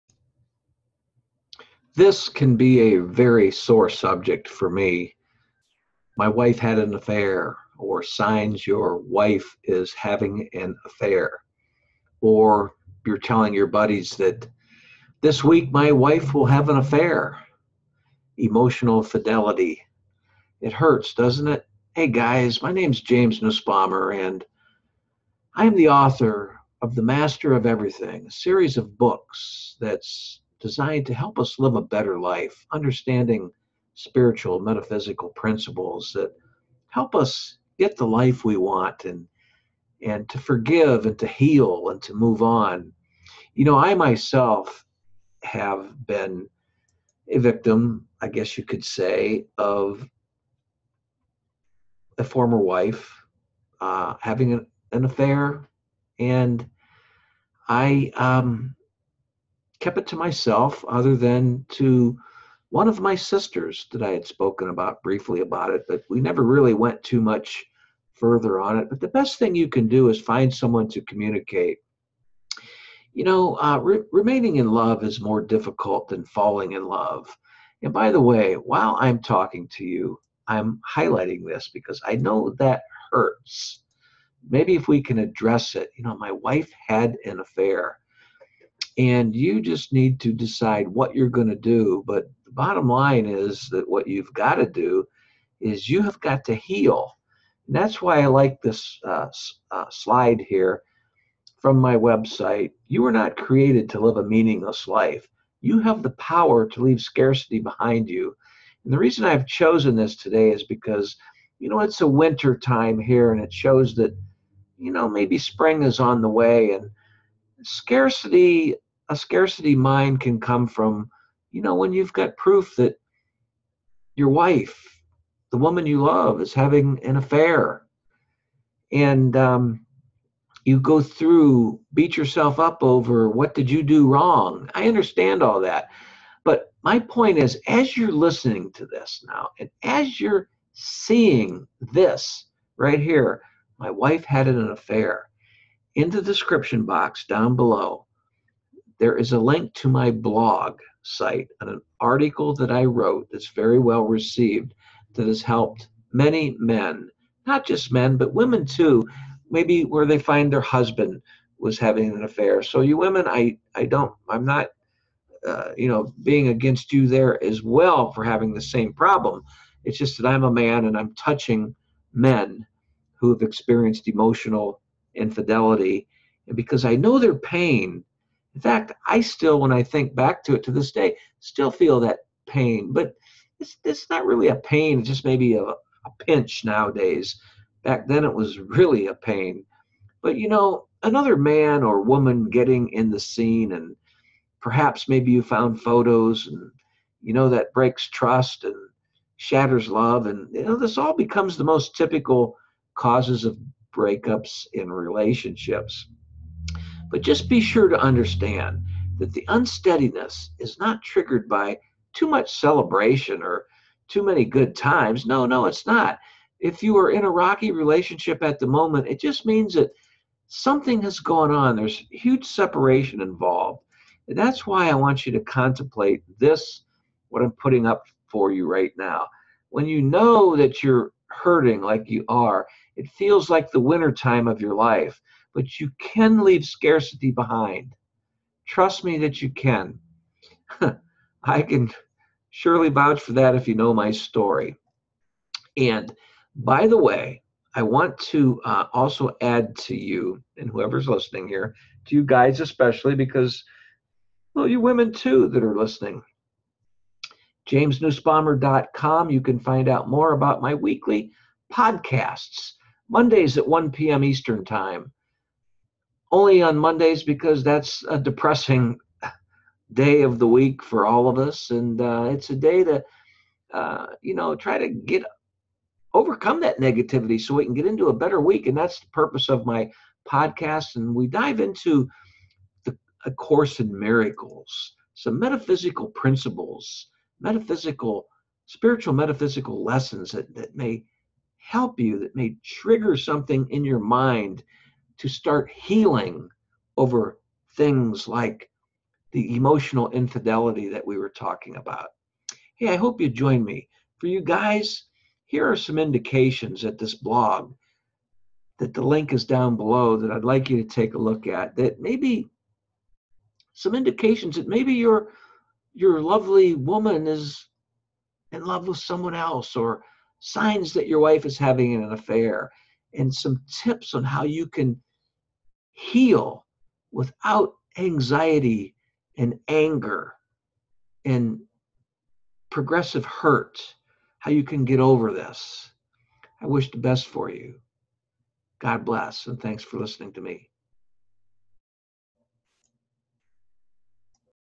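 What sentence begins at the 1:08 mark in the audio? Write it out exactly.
But the best thing you can do is find someone to communicate.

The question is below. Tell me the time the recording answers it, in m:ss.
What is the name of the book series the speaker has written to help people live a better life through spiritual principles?
0:26.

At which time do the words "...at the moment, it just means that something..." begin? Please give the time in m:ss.
3:38.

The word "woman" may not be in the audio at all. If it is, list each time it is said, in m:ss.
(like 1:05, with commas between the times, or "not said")
2:05, 3:12, 5:16.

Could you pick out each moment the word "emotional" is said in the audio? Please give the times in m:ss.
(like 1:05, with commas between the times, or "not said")
0:18, 2:54, 4:59.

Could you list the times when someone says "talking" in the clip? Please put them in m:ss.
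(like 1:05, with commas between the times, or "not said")
1:19, 5:01.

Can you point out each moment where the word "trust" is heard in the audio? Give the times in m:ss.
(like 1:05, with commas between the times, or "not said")
3:18, 3:58.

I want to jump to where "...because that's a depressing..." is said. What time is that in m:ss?
4:27.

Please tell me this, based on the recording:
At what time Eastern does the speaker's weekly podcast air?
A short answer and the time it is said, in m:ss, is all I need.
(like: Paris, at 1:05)
1 p.m., at 4:23.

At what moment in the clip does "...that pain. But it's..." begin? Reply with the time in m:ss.
3:02.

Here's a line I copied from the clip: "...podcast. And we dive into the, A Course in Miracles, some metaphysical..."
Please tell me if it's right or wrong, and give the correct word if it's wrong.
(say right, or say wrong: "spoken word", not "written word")
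right.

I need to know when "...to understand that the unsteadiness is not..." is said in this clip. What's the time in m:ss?
3:27.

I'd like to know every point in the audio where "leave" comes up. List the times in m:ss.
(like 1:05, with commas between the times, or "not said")
1:46, 3:56.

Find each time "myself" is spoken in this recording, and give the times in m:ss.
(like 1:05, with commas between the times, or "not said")
0:43, 1:00.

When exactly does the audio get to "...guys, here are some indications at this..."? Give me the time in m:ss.
5:04.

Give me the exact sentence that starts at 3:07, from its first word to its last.
Back then, it was really a pain.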